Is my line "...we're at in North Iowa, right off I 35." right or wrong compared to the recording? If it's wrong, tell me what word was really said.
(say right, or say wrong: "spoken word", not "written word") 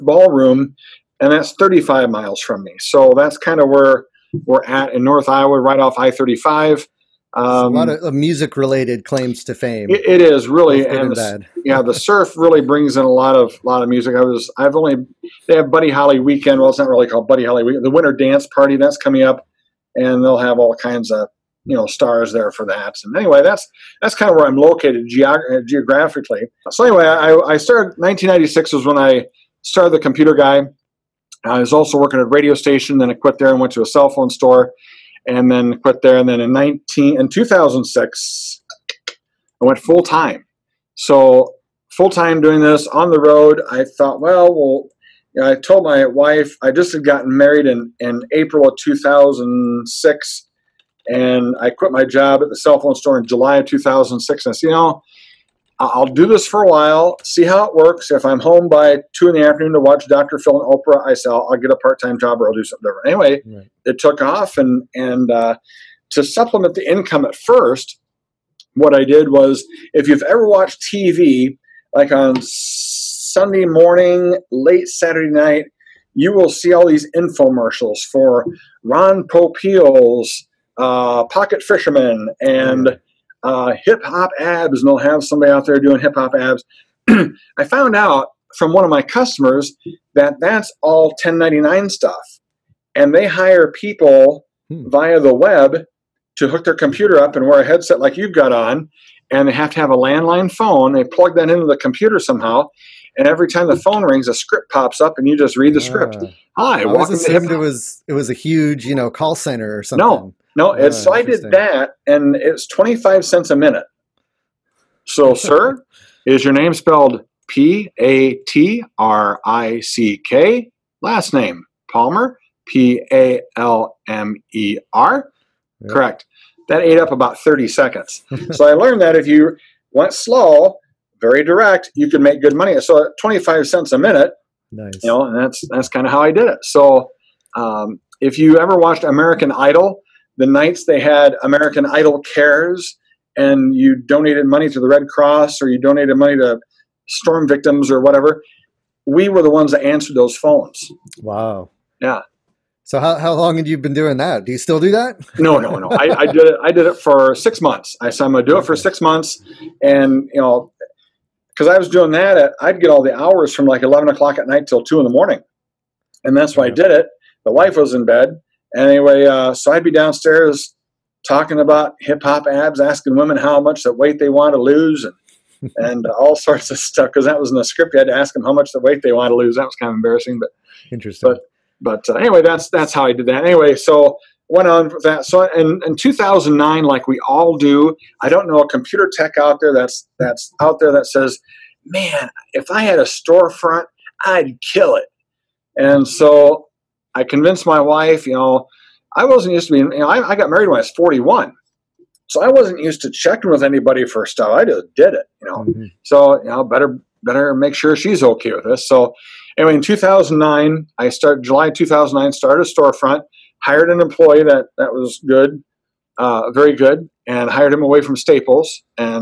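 right.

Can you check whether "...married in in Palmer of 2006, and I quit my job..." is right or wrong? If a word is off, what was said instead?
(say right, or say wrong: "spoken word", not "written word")
wrong: "April", not "Palmer".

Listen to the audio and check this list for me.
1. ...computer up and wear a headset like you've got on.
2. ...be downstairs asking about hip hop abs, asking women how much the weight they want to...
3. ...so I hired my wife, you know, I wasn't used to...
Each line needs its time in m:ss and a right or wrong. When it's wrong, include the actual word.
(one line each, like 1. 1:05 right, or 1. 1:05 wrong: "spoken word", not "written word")
1. 1:36 right
2. 2:49 wrong: "talking", not "asking"
3. 3:16 wrong: "convinced", not "hired".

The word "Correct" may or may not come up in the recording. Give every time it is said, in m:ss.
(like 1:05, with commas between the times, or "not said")
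2:05.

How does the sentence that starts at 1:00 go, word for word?
Phil and Oprah, I say I'll, I'll get a part-time job or I'll do something different.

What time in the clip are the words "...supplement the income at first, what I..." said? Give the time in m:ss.
1:06.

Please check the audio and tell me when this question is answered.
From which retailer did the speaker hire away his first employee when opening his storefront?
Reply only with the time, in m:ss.
3:38.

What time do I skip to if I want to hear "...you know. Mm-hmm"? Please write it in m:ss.
3:25.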